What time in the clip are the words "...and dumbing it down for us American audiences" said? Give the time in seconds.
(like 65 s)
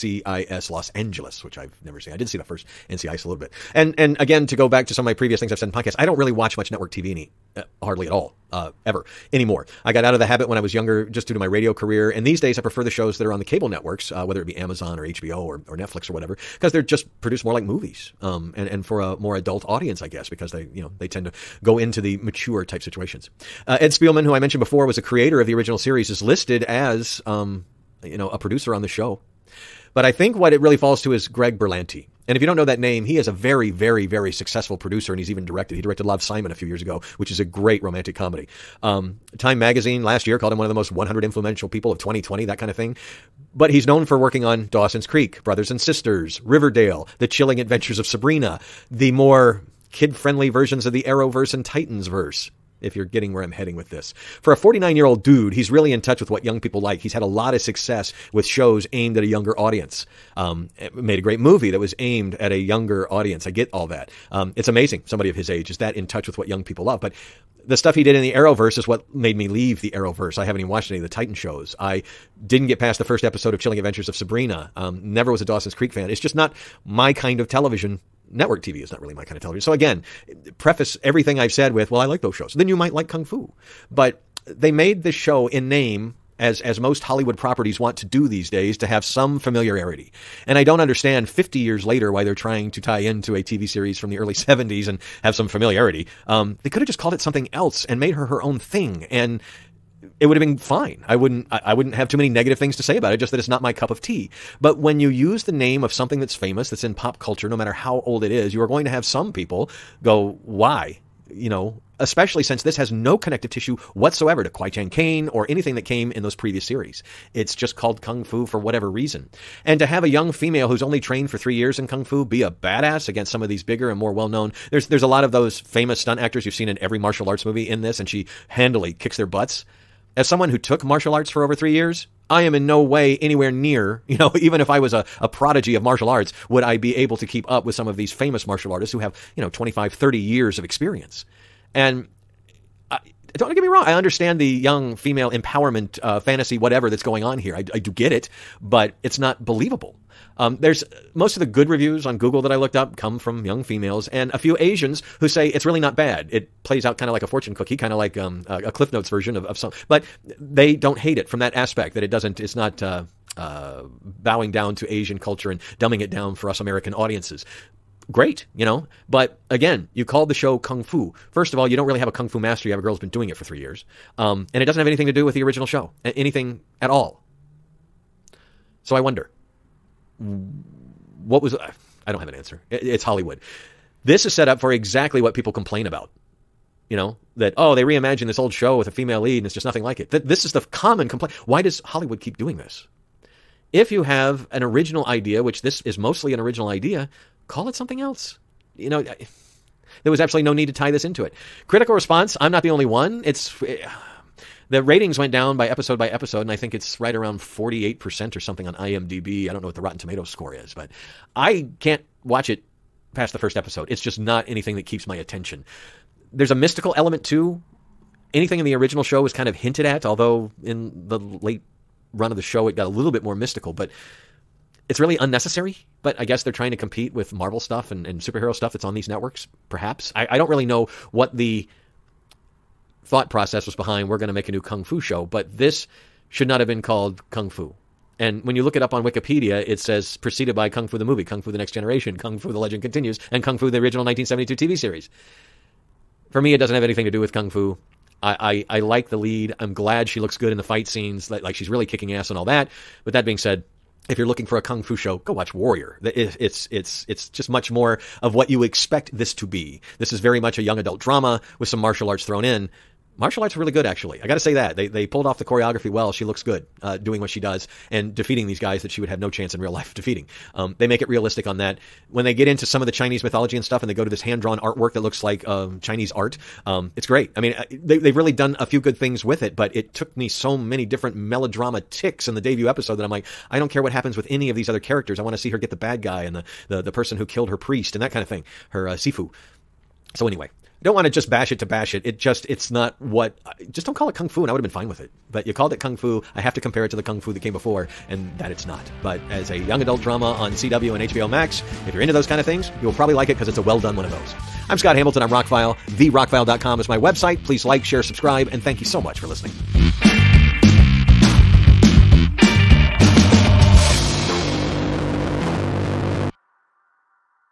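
165 s.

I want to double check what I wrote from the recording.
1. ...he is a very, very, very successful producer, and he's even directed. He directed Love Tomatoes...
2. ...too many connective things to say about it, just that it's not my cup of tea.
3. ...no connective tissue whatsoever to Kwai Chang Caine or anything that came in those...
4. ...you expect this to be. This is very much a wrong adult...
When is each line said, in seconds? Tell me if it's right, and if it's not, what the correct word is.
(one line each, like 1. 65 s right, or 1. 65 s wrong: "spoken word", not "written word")
1. 33 s wrong: "Simon", not "Tomatoes"
2. 102 s wrong: "negative", not "connective"
3. 112 s right
4. 258 s wrong: "young", not "wrong".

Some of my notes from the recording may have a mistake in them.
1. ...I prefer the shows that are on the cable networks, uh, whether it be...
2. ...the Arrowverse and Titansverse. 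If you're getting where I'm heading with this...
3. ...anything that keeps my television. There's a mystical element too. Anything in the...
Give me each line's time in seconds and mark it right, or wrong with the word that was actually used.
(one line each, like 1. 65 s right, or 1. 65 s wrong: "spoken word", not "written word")
1. 12 s right
2. 50 s right
3. 214 s wrong: "attention", not "television".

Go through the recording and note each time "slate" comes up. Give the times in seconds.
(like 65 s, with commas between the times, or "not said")
not said.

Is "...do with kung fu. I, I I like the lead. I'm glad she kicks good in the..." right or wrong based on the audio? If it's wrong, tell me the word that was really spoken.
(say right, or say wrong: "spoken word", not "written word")
wrong: "looks", not "kicks".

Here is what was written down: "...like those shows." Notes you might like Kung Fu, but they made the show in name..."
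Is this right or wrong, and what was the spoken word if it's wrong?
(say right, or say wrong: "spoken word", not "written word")
wrong: "Then", not "Notes".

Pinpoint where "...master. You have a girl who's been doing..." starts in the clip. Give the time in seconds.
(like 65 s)
172 s.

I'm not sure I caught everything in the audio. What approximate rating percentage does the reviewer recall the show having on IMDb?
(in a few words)
48%.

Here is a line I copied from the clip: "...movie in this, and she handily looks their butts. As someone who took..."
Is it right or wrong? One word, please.
wrong.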